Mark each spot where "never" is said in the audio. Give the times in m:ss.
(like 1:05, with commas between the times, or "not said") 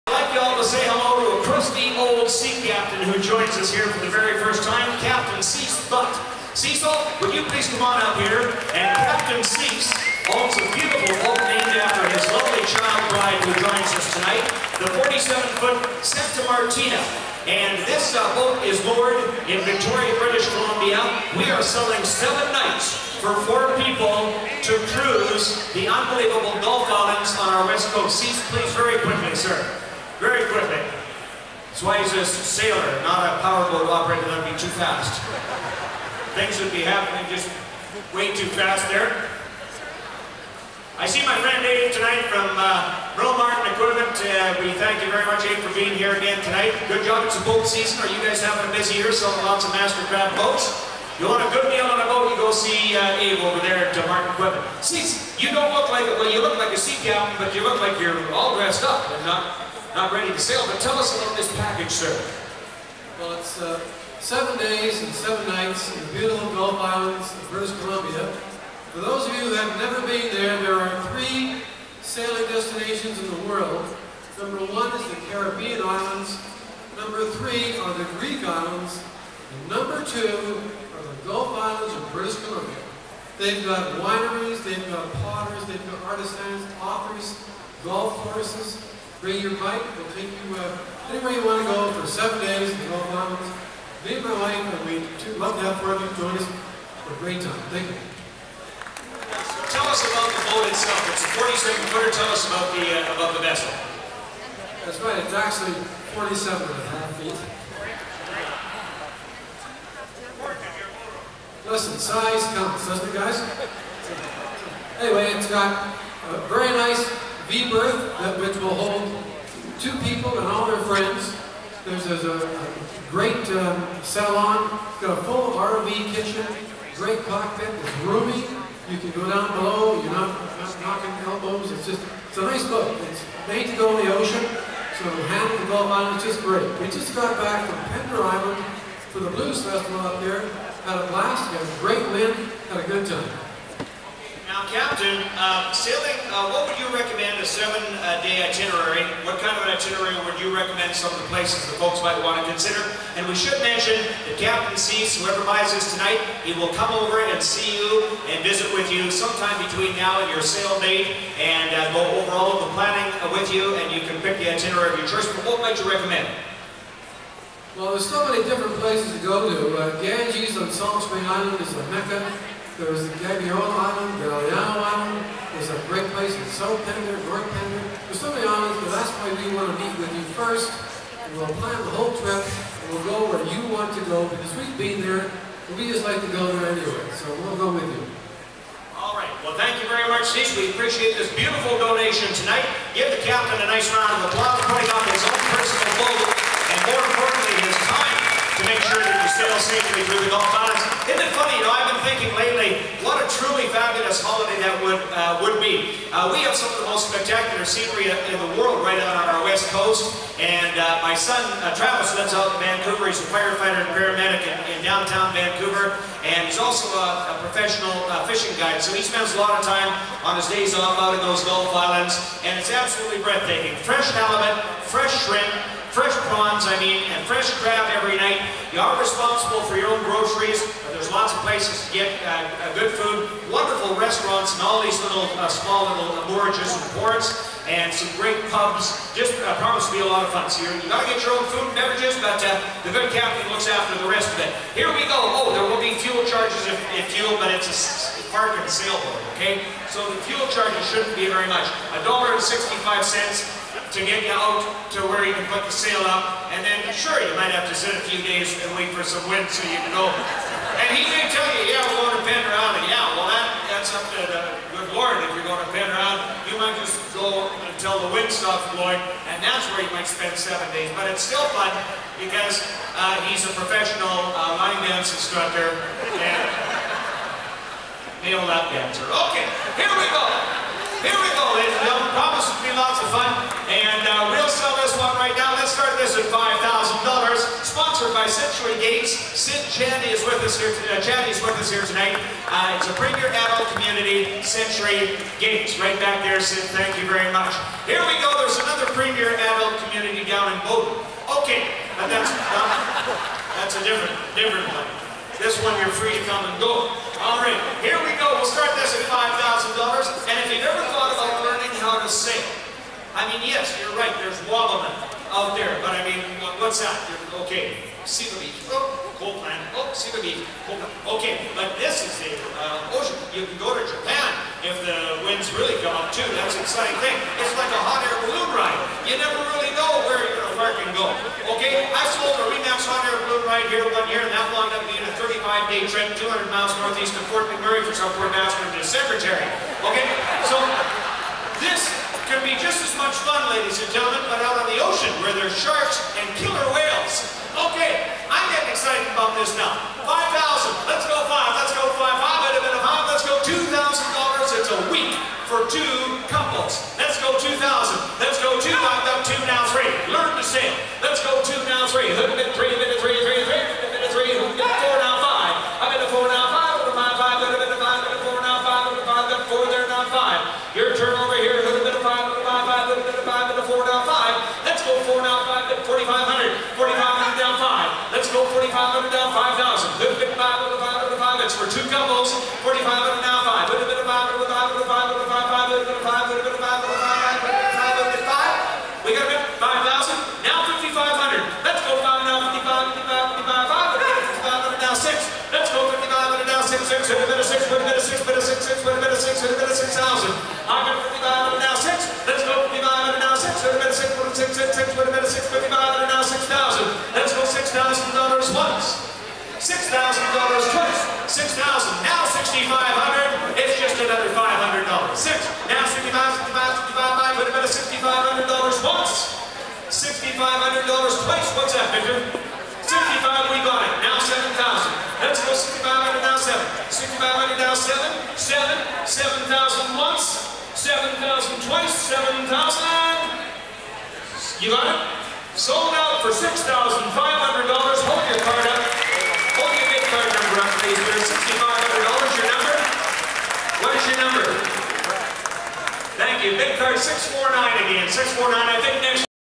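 1:09, 5:29.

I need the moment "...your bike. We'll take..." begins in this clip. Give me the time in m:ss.
1:29.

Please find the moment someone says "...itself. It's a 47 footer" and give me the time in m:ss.
1:40.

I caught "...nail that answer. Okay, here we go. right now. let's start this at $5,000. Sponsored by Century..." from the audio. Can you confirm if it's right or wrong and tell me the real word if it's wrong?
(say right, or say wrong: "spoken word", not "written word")
right.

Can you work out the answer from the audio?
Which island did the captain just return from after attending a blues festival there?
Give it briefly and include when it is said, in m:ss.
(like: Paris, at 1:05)
Pender Island, at 2:17.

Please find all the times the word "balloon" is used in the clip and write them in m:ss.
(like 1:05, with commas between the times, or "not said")
5:28, 5:33.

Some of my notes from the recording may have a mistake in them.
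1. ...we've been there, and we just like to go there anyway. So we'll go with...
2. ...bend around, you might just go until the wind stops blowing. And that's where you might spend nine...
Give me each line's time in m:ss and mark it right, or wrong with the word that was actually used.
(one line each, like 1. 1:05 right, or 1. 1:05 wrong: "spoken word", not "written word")
1. 3:04 right
2. 4:25 wrong: "seven", not "nine".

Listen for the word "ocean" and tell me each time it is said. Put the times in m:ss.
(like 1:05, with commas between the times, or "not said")
2:14, 5:22, 5:44.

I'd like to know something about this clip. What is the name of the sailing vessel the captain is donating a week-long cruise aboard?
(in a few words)
Santa Martina.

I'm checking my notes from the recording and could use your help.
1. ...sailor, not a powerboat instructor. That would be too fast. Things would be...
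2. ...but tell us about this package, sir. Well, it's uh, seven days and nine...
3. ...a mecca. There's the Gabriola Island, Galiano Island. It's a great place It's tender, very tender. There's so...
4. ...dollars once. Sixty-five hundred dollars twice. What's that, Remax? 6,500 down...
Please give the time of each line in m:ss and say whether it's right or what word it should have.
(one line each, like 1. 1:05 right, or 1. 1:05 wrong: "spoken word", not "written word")
1. 0:32 wrong: "operator", not "instructor"
2. 1:00 wrong: "seven", not "nine"
3. 2:51 right
4. 6:58 wrong: "Victor", not "Remax".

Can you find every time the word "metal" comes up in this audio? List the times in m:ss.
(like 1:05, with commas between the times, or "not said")
not said.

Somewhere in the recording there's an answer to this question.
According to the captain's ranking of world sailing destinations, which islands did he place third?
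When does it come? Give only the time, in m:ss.
1:17.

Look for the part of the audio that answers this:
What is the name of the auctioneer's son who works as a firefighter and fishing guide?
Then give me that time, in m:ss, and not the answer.
3:31.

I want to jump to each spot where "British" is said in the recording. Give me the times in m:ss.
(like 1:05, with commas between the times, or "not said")
0:20, 1:07, 1:22.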